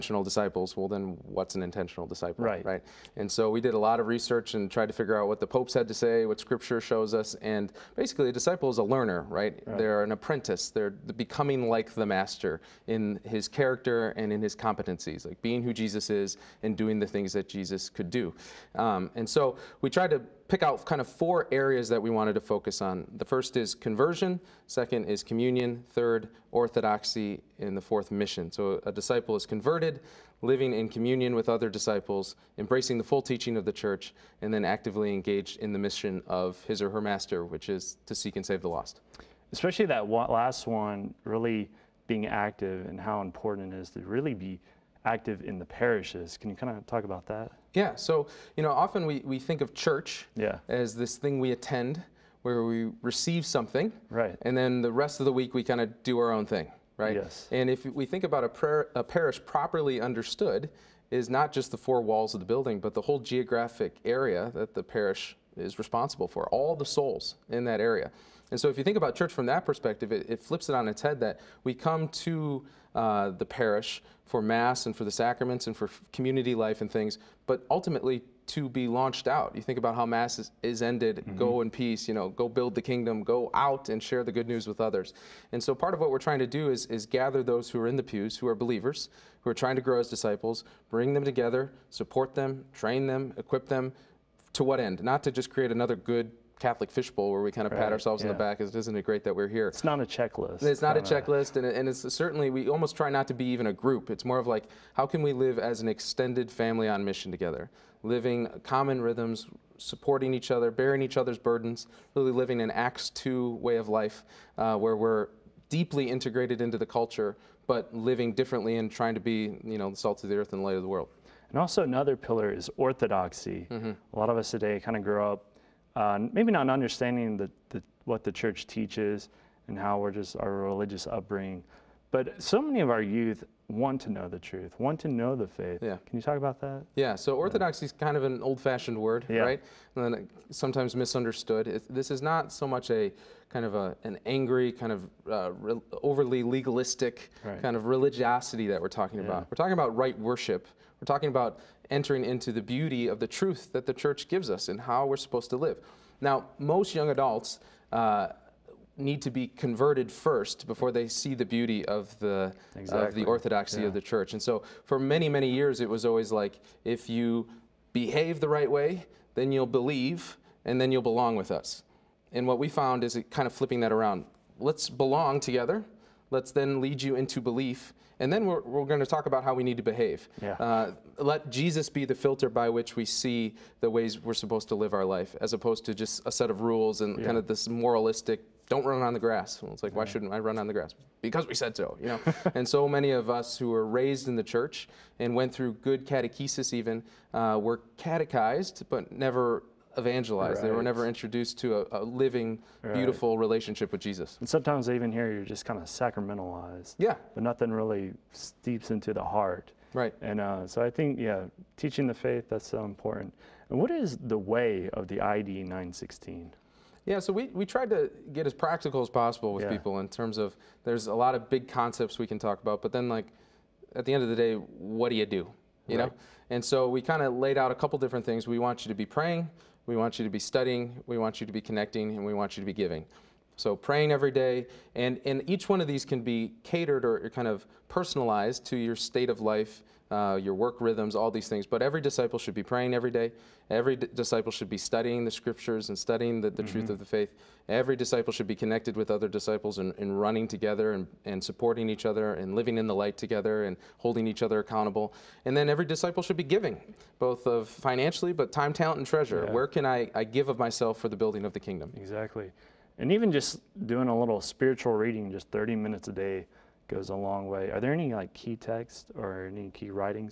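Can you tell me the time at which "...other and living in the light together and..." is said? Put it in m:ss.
4:12.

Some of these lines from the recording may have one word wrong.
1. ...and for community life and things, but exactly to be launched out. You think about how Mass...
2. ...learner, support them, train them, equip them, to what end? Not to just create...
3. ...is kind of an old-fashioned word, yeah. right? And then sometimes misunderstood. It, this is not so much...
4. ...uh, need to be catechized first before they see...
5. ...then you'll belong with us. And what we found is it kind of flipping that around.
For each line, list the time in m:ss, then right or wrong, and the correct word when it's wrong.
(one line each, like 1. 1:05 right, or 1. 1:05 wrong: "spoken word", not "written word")
1. 1:15 wrong: "ultimately", not "exactly"
2. 1:31 wrong: "together", not "learner"
3. 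2:17 right
4. 2:37 wrong: "converted", not "catechized"
5. 2:50 right.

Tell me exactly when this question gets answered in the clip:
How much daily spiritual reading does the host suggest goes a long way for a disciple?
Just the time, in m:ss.
4:25.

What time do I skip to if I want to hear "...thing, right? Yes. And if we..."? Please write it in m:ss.
0:56.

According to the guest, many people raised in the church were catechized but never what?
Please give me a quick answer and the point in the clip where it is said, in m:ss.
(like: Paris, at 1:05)
Evangelized, at 3:19.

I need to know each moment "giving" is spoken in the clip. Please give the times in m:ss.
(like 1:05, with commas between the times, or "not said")
3:52, 4:16.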